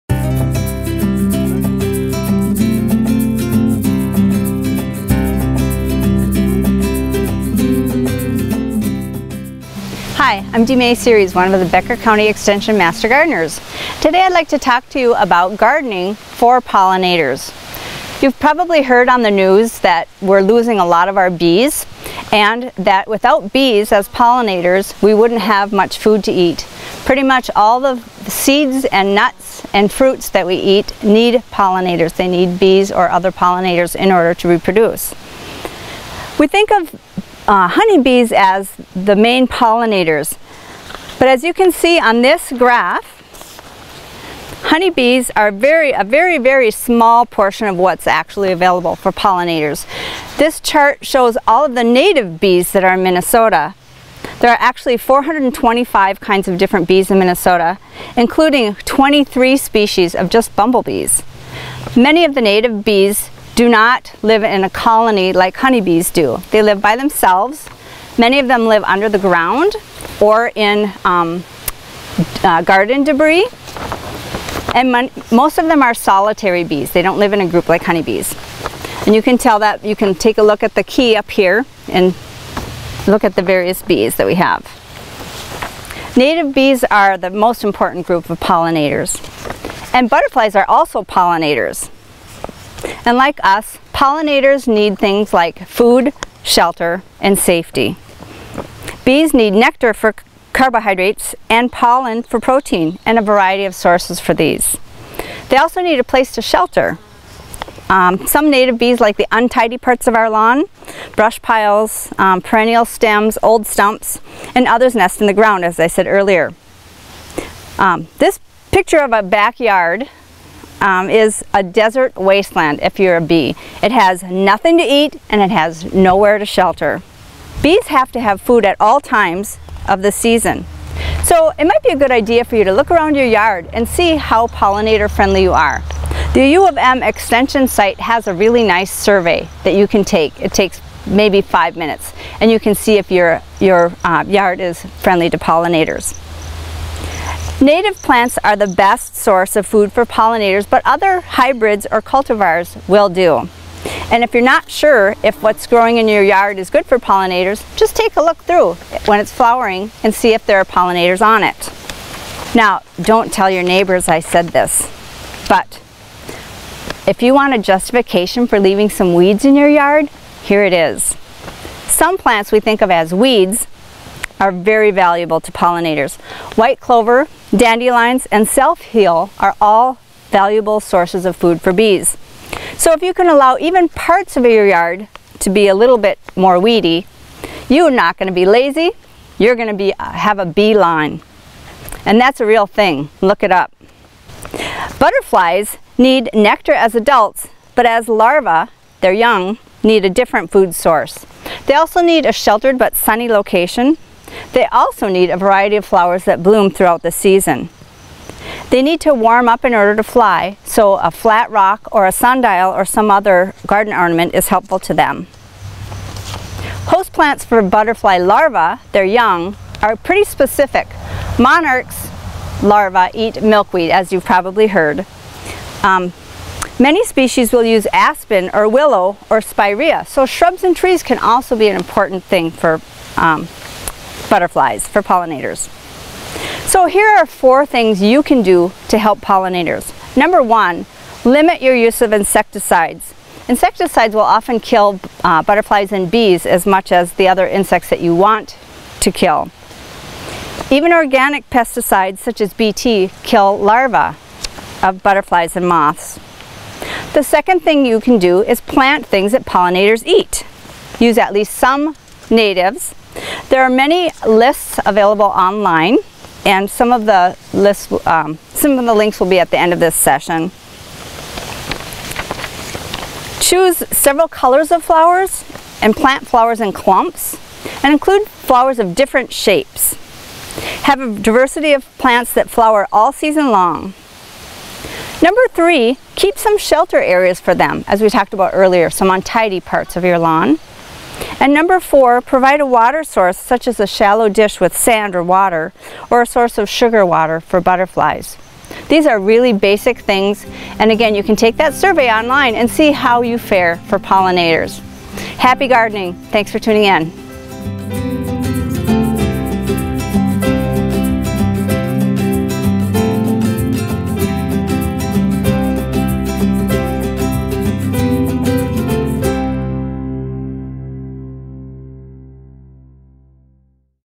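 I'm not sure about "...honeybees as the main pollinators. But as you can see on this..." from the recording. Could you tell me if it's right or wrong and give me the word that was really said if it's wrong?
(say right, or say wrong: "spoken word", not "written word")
right.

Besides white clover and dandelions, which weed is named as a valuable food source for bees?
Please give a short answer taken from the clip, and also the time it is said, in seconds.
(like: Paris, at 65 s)
Self-heal, at 178 s.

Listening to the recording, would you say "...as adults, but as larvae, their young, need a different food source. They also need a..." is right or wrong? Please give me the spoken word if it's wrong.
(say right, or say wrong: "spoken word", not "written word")
right.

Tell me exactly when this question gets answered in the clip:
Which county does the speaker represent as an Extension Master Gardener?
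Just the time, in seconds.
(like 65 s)
11 s.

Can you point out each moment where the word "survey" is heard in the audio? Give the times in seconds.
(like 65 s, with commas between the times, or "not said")
138 s, 301 s.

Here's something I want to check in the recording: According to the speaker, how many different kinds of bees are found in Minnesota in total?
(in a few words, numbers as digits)
425.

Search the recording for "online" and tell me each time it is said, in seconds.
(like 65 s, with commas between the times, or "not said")
265 s, 302 s.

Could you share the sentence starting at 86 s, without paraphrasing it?
Native bees are the most important group of pollinators.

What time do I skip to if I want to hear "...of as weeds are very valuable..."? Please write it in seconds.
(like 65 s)
172 s.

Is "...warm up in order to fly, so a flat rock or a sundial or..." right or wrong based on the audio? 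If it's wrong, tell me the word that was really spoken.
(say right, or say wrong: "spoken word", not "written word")
right.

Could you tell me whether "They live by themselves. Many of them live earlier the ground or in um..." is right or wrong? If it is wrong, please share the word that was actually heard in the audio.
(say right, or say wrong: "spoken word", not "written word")
wrong: "under", not "earlier".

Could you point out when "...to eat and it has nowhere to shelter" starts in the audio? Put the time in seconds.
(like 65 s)
124 s.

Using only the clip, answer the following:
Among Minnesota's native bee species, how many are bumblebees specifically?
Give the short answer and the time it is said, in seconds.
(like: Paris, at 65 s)
23, at 58 s.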